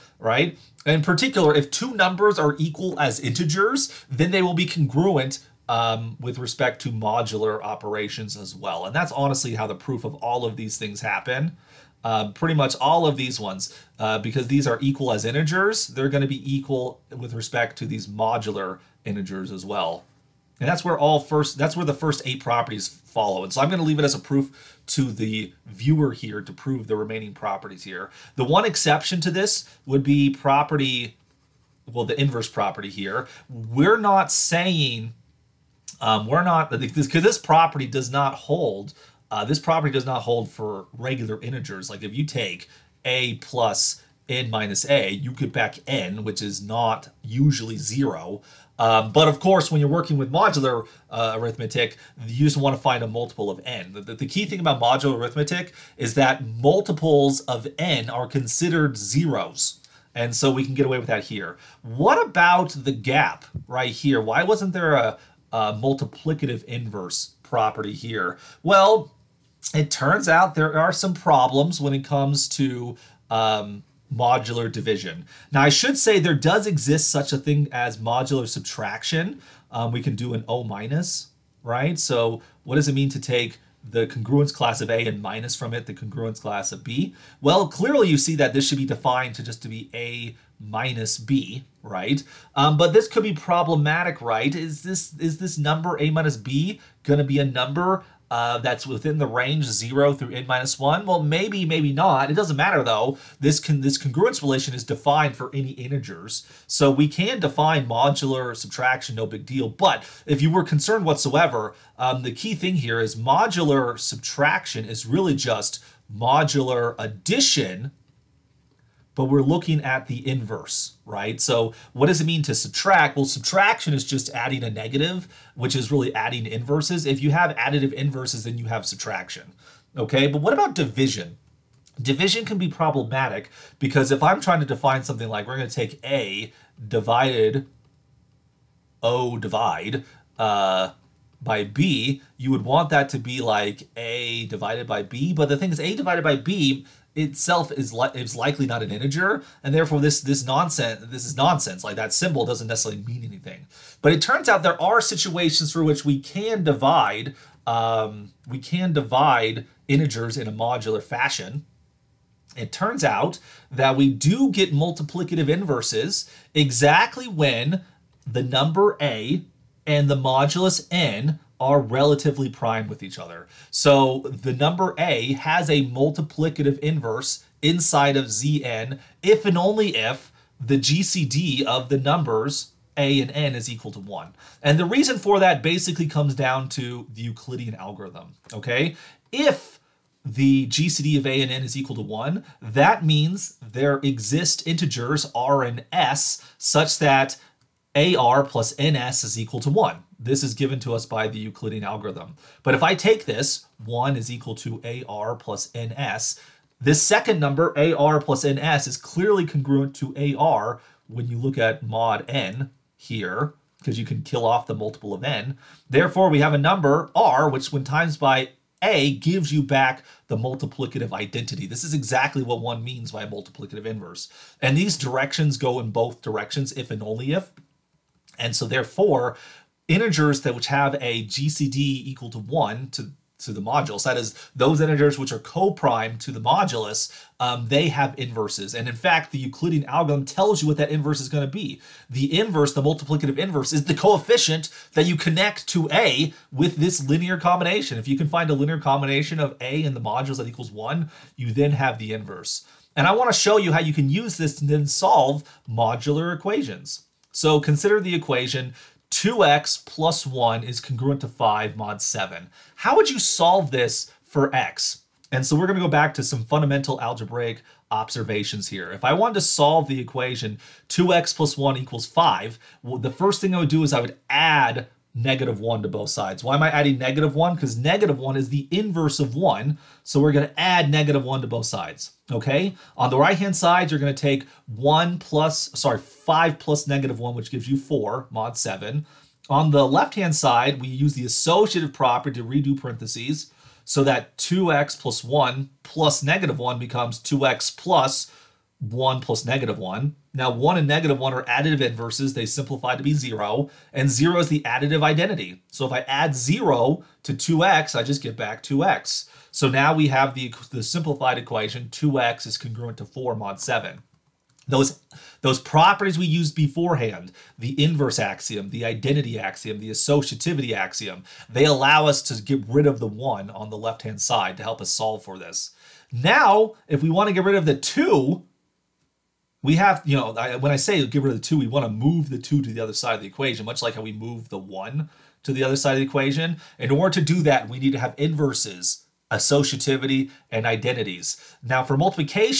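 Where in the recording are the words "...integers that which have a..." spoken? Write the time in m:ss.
3:49.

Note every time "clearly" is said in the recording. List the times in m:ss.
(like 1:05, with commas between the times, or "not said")
1:27, 3:28.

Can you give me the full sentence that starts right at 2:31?
Like that symbol doesn't necessarily mean anything.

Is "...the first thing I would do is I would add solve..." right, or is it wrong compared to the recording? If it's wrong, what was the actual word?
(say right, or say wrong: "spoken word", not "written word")
wrong: "negative", not "solve".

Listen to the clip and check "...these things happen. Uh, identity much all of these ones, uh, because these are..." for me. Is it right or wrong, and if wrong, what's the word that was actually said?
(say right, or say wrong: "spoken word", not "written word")
wrong: "pretty", not "identity".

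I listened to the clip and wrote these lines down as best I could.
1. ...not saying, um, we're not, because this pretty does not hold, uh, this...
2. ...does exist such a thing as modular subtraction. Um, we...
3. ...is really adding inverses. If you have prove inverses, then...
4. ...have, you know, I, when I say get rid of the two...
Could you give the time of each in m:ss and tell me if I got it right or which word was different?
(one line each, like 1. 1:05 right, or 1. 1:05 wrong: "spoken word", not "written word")
1. 0:33 wrong: "property", not "pretty"
2. 1:16 right
3. 2:05 wrong: "additive", not "prove"
4. 5:29 right.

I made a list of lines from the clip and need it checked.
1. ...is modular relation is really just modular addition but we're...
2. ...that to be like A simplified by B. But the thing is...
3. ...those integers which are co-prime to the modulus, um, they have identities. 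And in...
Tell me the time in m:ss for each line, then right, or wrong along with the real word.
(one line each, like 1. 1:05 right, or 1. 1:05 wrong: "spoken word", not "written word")
1. 1:53 wrong: "subtraction", not "relation"
2. 2:22 wrong: "divided", not "simplified"
3. 3:54 wrong: "inverses", not "identities".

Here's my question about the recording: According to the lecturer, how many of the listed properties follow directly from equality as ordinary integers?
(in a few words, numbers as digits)
8.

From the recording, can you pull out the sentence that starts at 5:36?
In order to do that, we need to have inverses, associativity, and identities.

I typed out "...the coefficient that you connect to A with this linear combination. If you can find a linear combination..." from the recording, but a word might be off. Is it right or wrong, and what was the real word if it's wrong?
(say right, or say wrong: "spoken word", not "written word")
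right.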